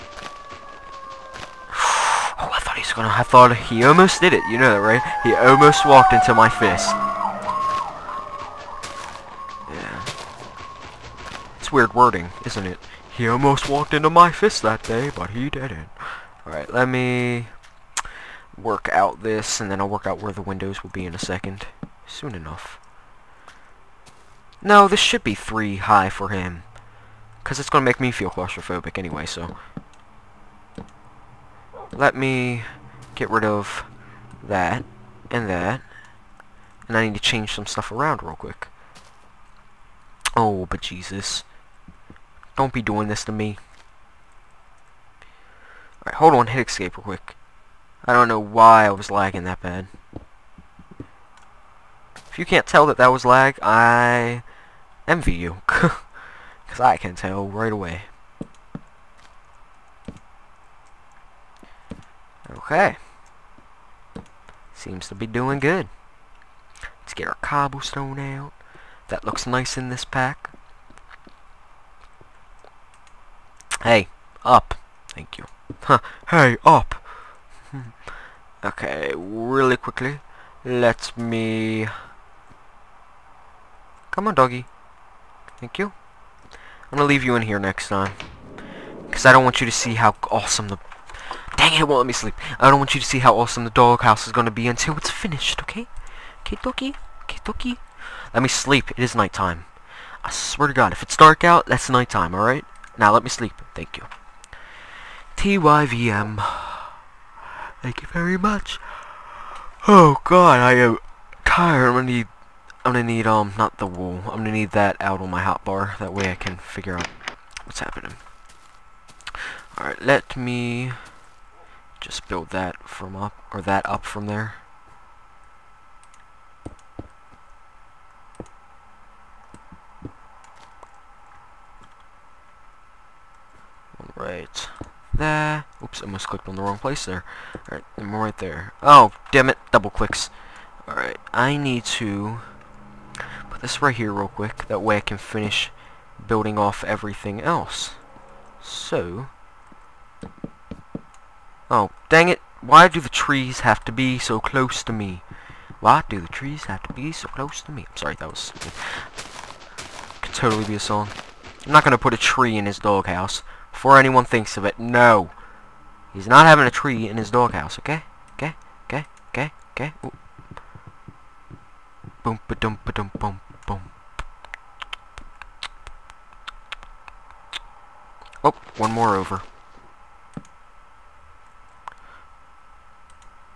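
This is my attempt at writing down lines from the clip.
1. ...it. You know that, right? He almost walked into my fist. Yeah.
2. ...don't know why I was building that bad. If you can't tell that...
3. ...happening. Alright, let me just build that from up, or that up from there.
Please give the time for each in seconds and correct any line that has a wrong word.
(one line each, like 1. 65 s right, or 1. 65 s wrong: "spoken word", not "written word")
1. 4 s right
2. 48 s wrong: "lagging", not "building"
3. 117 s right.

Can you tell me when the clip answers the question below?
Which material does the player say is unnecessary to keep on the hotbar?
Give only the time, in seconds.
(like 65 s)
113 s.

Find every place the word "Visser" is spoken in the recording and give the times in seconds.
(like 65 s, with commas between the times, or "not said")
not said.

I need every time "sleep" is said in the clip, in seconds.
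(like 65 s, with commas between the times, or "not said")
92 s, 98 s, 103 s.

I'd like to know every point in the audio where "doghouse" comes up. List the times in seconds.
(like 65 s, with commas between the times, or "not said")
93 s, 162 s, 167 s.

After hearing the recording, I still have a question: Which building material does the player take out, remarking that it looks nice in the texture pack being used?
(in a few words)
cobblestone.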